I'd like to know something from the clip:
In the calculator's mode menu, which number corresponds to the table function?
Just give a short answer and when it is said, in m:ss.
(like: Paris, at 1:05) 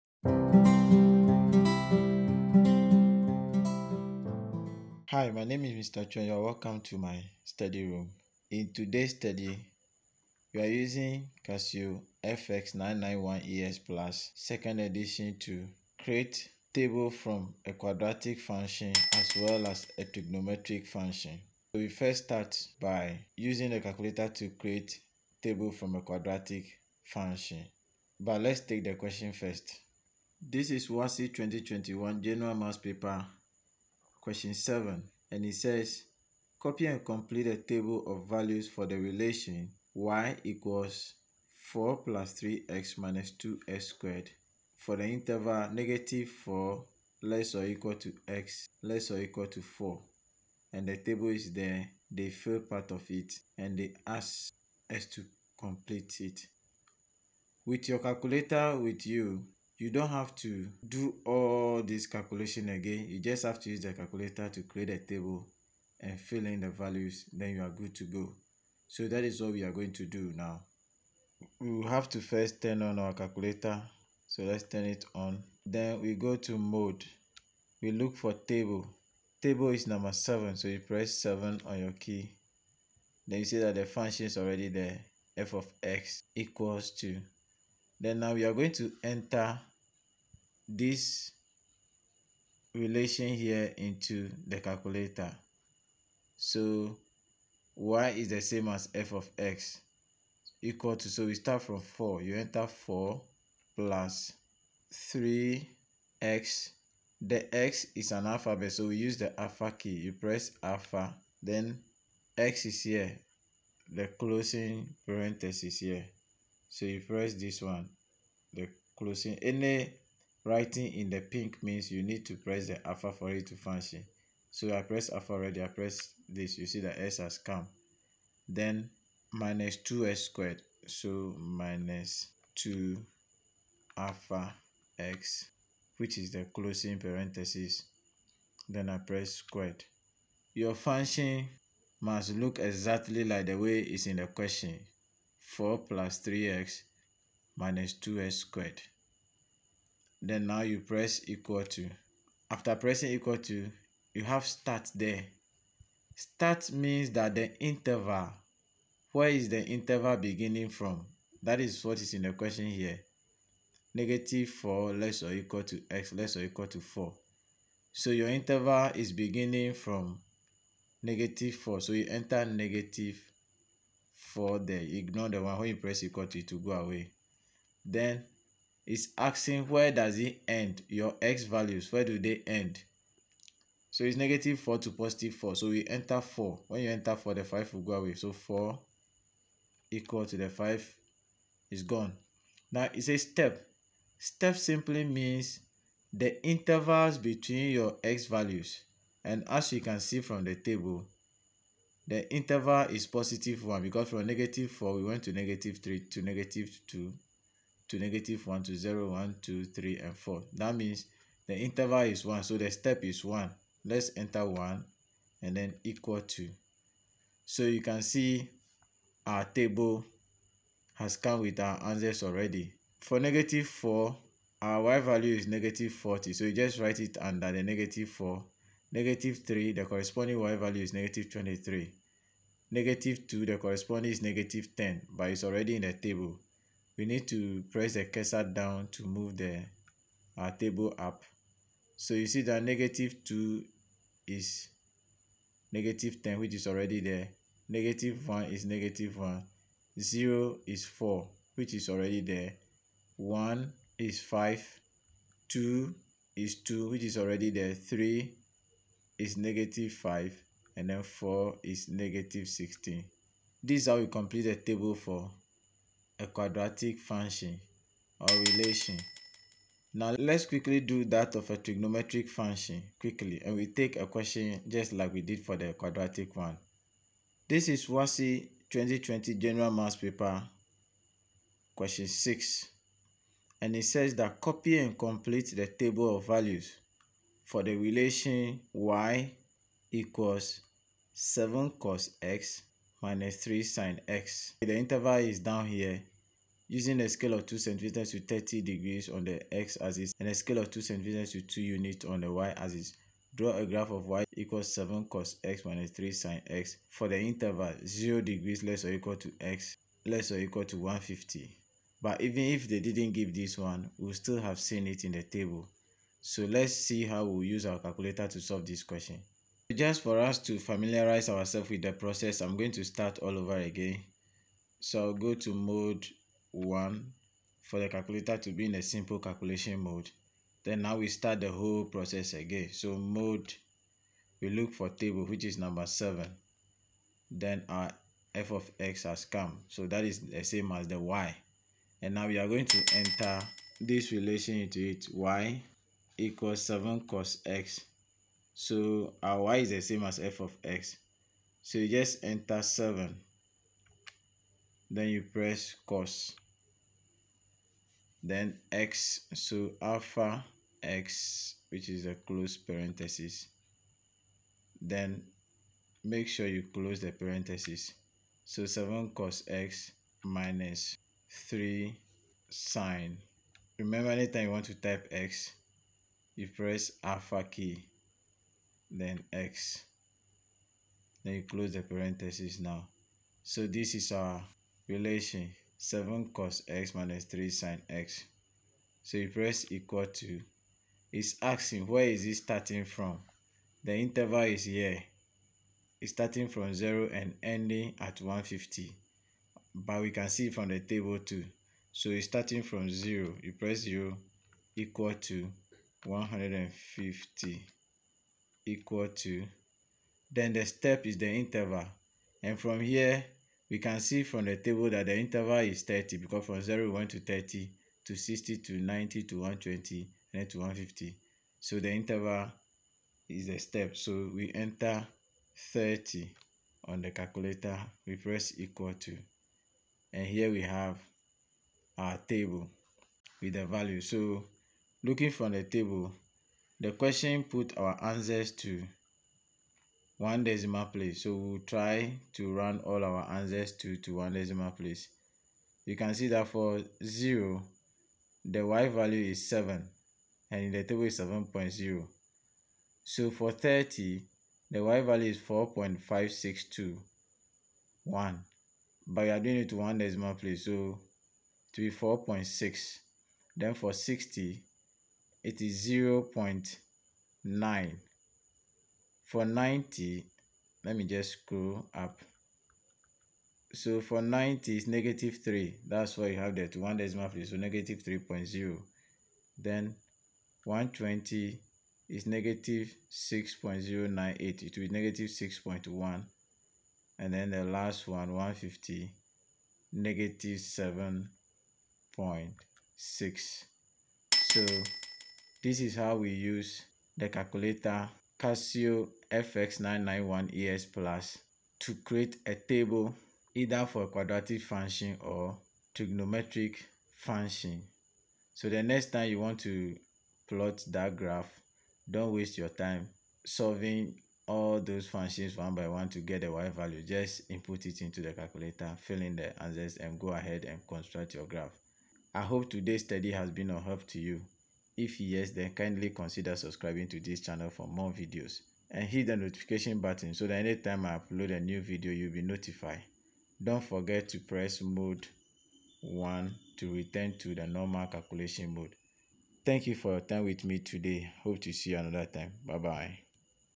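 7, at 1:19.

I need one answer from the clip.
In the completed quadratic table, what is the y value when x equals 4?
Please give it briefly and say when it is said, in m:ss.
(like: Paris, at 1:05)
-16, at 4:21.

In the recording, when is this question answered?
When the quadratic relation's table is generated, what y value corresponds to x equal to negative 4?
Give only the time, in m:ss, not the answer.
3:45.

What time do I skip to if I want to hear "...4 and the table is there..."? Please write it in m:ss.
0:49.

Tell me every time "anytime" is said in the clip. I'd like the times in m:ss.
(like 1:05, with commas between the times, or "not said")
6:14, 8:50.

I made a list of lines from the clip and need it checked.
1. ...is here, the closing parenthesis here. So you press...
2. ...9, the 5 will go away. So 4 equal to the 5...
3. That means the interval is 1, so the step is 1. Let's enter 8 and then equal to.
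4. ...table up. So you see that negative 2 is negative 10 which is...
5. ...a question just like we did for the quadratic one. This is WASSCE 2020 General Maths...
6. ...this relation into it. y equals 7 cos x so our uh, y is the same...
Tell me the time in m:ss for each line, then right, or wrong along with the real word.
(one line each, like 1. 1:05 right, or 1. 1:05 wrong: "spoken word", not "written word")
1. 1:52 right
2. 3:07 wrong: "4", not "9"
3. 3:30 wrong: "1", not "8"
4. 4:00 right
5. 4:33 right
6. 5:43 right.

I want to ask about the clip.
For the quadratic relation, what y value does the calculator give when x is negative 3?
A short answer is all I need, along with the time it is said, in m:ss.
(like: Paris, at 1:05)
-23, at 3:50.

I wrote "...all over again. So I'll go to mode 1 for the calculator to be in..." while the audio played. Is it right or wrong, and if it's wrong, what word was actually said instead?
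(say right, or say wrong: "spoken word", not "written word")
right.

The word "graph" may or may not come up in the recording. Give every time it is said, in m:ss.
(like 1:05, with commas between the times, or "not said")
5:03, 8:31, 8:41.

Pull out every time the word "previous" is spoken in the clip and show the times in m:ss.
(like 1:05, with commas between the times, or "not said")
not said.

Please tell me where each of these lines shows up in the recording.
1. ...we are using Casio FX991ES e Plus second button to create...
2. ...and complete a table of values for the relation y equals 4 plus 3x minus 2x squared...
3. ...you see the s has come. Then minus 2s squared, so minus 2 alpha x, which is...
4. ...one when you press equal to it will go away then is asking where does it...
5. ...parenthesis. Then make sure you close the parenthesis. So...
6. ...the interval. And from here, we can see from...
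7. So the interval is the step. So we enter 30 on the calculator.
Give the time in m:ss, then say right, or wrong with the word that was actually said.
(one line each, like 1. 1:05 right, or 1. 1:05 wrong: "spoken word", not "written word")
1. 0:10 wrong: "edition", not "button"
2. 0:36 right
3. 2:06 right
4. 2:55 right
5. 6:02 right
6. 6:51 right
7. 7:01 right.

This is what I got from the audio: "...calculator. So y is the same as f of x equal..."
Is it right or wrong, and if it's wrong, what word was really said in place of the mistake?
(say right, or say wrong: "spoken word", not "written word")
right.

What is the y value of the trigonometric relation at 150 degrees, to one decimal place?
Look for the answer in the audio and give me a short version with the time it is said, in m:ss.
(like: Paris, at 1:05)
-7.6, at 8:09.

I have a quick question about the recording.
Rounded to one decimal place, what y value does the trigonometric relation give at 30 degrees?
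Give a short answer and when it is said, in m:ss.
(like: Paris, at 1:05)
4.6, at 7:41.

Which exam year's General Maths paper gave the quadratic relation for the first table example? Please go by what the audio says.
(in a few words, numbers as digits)
2021.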